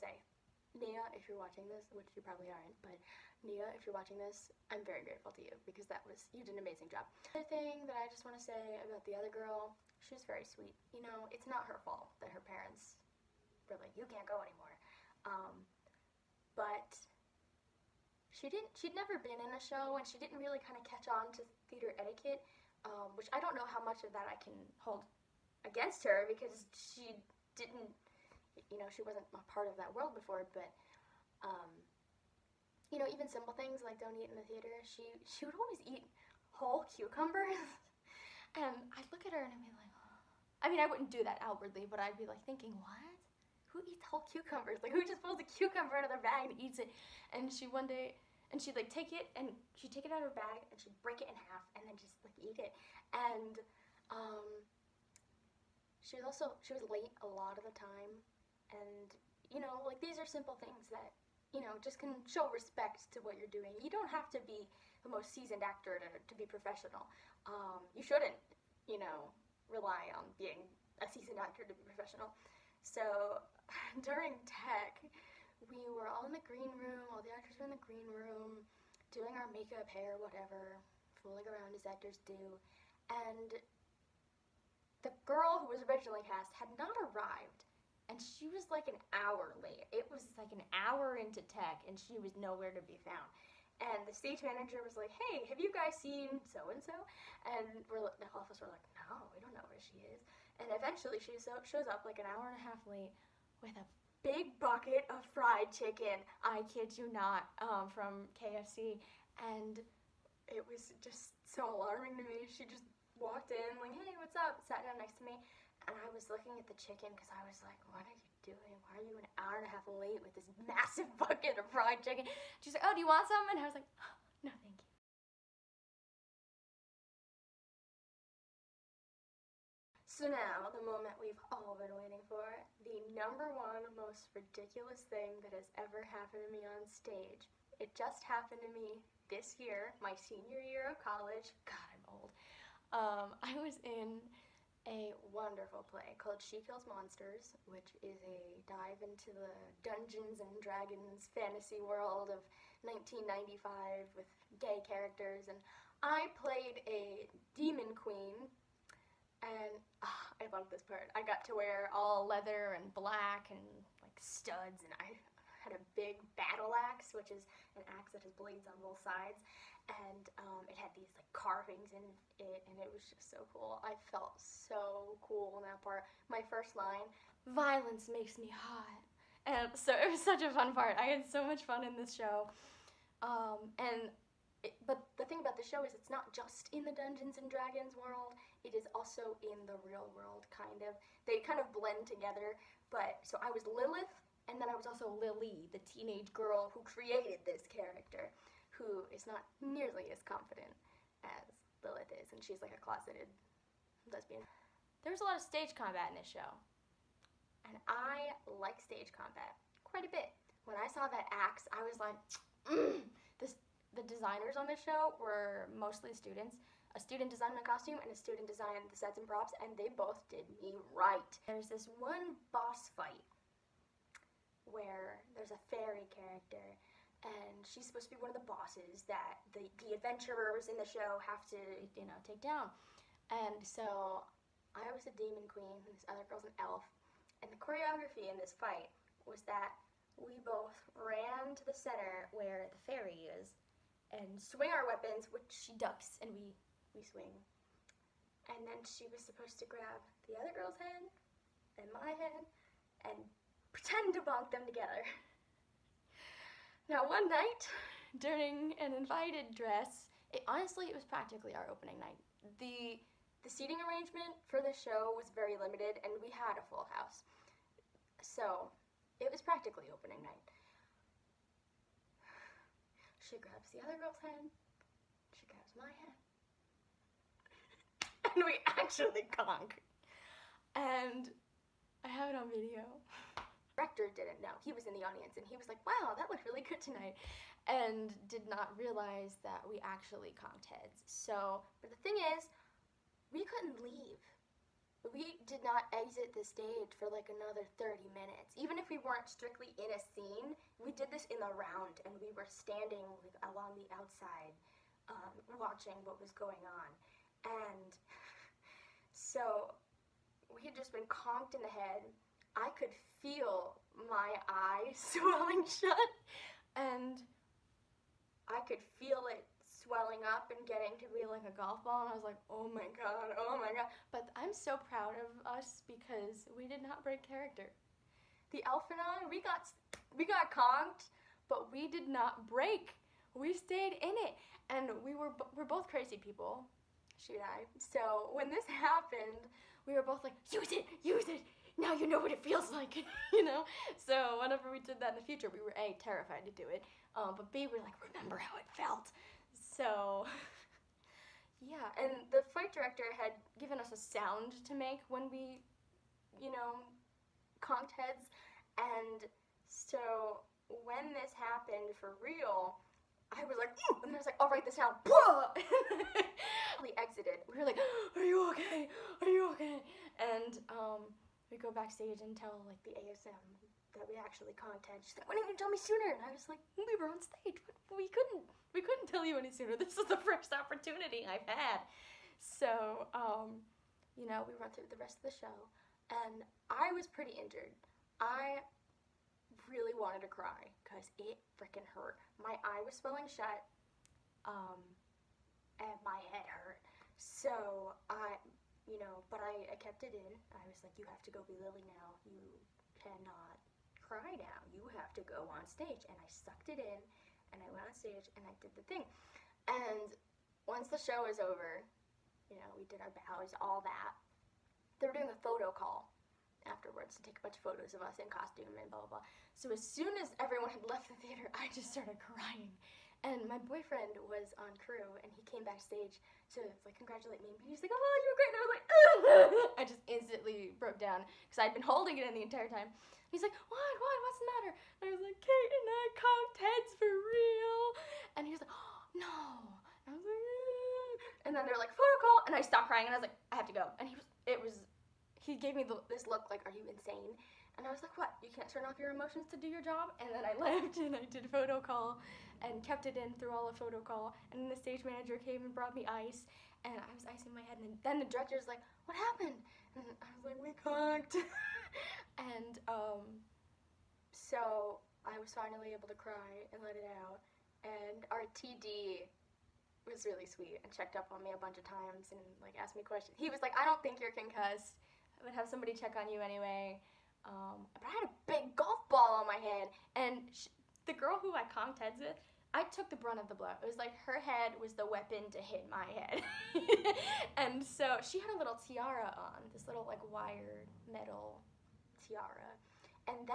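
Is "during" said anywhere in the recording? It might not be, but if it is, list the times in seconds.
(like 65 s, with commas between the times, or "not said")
74 s, 258 s.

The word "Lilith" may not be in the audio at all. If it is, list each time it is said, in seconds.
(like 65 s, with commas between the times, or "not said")
193 s, 201 s.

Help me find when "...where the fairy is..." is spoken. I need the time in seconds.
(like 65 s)
242 s.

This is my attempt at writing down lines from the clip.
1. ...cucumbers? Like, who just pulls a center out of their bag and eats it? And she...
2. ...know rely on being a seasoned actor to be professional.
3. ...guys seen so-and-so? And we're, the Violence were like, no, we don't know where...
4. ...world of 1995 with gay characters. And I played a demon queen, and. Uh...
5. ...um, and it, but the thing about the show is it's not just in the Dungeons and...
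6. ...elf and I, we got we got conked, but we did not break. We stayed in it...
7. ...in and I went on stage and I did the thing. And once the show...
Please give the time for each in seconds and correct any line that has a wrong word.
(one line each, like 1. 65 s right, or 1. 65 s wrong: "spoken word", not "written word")
1. 44 s wrong: "cucumber", not "center"
2. 69 s right
3. 95 s wrong: "office", not "Violence"
4. 151 s right
5. 183 s right
6. 328 s right
7. 406 s right.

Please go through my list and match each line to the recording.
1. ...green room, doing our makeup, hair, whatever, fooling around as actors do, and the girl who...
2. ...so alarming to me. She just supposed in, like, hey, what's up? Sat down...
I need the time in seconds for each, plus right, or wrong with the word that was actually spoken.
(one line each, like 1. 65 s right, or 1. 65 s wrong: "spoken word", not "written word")
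1. 77 s right
2. 111 s wrong: "walked", not "supposed".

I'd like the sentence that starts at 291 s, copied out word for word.
So, but the thing is, we couldn't leave we did not exit the stage for like another 30 minutes.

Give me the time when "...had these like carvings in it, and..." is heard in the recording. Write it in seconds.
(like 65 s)
170 s.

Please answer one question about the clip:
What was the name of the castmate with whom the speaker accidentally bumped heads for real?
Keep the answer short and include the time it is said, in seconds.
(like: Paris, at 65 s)
Kate, at 435 s.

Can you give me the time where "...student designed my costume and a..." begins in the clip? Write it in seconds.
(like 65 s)
217 s.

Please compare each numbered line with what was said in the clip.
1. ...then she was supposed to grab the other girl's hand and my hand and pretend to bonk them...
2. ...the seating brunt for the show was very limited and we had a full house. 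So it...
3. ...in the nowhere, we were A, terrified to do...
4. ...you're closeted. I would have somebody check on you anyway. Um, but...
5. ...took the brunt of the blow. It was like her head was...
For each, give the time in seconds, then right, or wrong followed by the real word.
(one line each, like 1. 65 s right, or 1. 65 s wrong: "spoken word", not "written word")
1. 248 s right
2. 263 s wrong: "arrangement", not "brunt"
3. 345 s wrong: "future", not "nowhere"
4. 474 s wrong: "concussed", not "closeted"
5. 482 s right.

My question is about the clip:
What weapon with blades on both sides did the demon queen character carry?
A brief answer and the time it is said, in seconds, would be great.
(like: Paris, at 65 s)
Battle axe, at 166 s.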